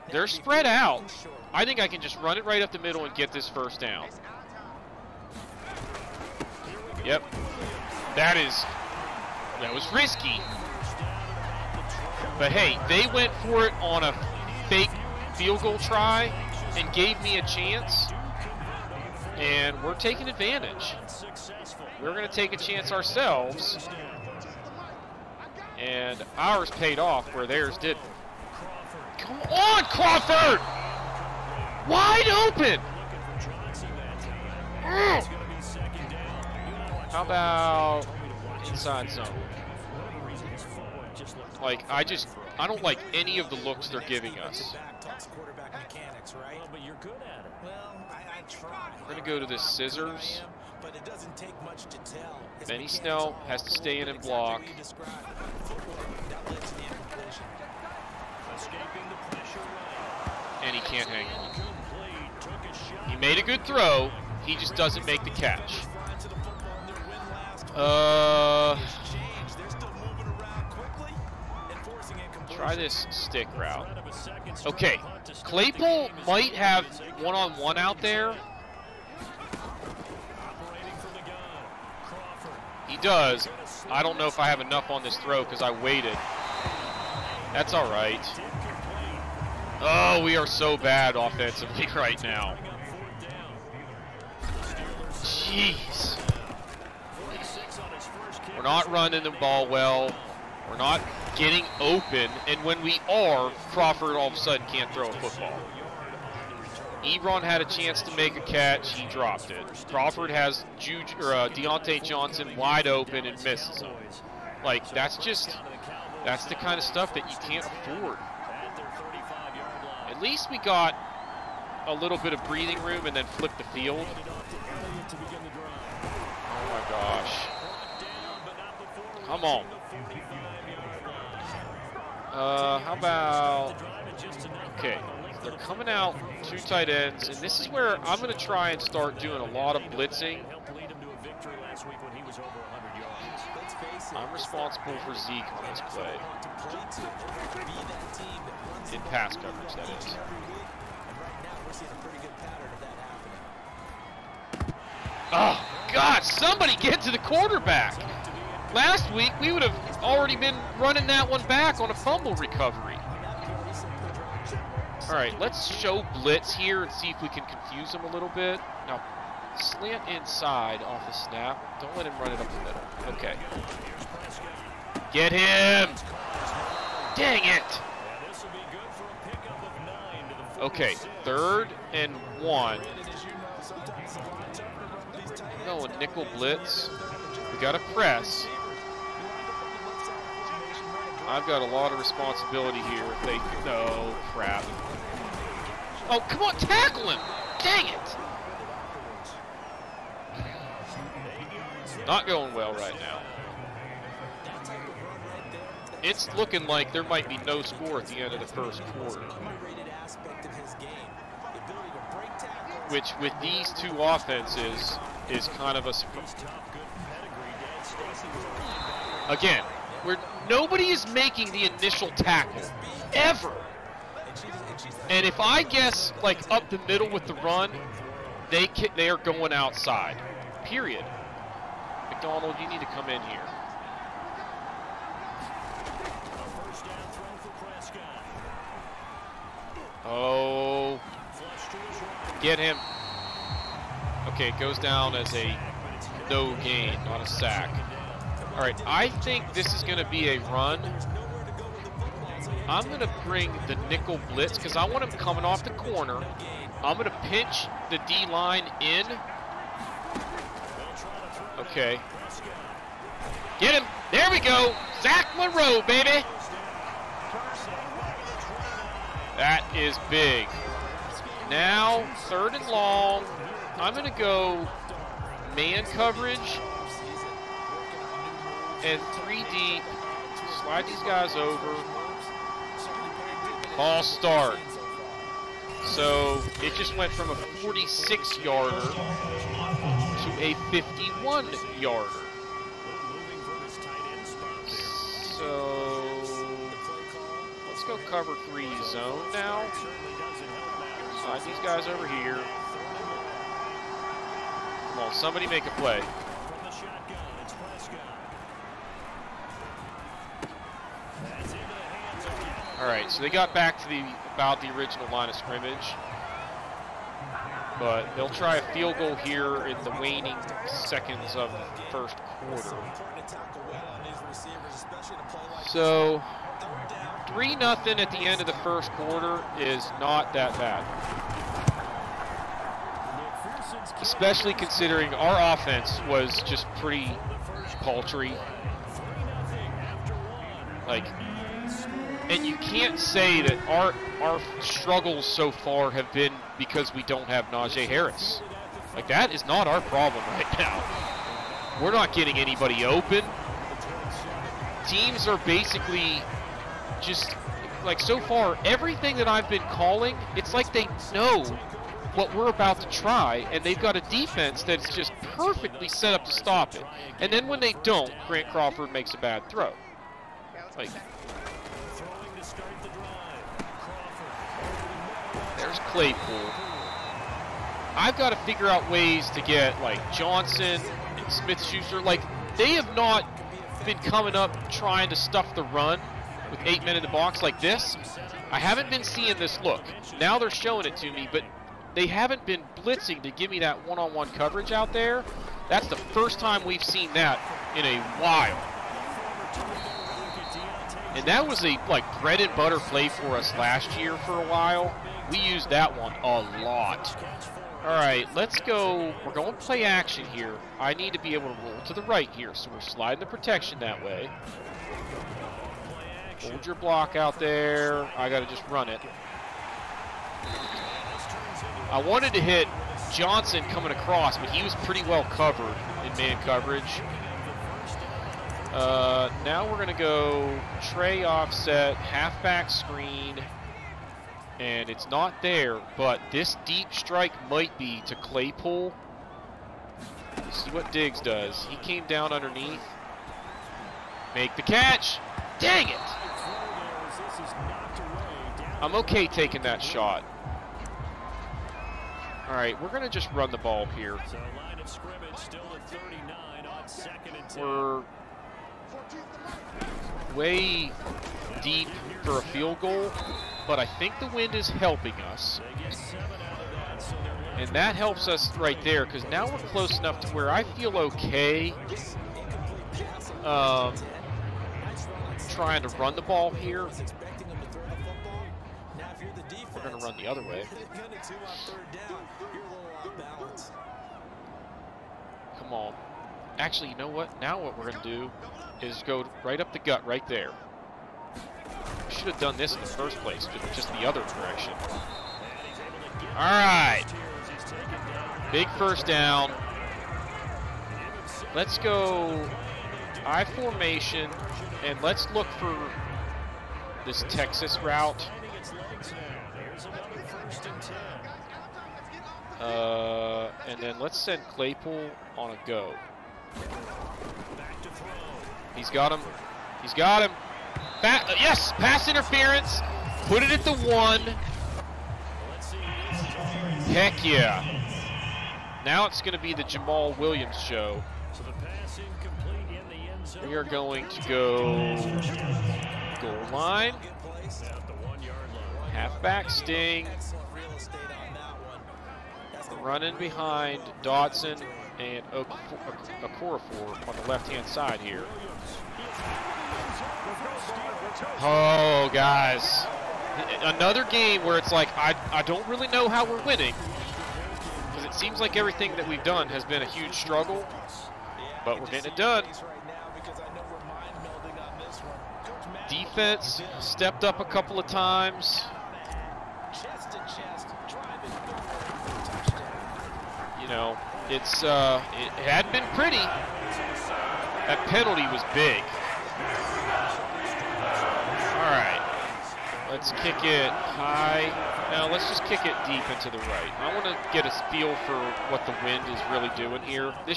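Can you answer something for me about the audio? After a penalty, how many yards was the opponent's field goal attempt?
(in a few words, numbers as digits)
51.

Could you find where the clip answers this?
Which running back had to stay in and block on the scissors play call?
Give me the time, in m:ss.
0:52.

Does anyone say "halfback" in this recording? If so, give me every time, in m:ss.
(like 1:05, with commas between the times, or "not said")
7:11, 8:58.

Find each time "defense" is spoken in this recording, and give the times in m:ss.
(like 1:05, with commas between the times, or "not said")
6:04, 9:25.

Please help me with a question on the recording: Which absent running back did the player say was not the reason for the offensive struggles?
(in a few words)
Najee Harris.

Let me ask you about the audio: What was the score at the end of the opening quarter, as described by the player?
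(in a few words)
3-0.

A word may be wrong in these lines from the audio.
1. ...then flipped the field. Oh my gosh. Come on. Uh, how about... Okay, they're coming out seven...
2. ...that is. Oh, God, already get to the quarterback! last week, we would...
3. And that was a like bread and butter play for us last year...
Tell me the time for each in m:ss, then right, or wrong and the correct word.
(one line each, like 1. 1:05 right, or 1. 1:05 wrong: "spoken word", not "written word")
1. 2:03 wrong: "two", not "seven"
2. 2:29 wrong: "somebody", not "already"
3. 6:41 right.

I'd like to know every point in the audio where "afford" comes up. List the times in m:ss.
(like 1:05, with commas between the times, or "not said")
1:57.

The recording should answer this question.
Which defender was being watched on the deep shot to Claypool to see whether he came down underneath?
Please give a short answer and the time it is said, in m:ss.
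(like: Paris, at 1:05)
Diggs, at 7:20.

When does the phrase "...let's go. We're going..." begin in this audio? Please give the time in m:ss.
6:48.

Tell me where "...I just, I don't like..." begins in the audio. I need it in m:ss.
0:41.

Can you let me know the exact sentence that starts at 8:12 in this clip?
Should have done this in the first place, just the other direction.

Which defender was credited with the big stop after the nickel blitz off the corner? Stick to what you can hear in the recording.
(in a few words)
Zach Monroe.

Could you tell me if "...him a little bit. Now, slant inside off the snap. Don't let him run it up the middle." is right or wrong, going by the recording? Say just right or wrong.
right.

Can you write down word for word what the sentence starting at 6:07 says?
And then when they don't, Grant Crawford makes a bad throw.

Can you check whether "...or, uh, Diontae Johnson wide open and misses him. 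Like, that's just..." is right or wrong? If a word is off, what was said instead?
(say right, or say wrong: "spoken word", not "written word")
right.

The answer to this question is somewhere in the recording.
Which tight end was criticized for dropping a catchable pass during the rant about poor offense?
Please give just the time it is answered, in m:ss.
1:47.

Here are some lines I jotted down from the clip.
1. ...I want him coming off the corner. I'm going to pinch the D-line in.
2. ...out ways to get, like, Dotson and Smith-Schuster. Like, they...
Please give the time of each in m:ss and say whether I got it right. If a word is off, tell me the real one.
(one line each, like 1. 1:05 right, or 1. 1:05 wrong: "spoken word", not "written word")
1. 4:14 right
2. 6:18 wrong: "Johnson", not "Dotson".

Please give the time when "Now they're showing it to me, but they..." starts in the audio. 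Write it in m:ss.
6:30.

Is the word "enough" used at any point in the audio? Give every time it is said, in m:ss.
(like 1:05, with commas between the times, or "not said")
1:24, 7:49.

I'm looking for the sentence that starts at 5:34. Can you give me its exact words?
Especially considering our offense was just pretty paltry.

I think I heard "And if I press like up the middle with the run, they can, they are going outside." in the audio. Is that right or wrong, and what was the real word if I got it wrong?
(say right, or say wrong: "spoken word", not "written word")
wrong: "guess", not "press".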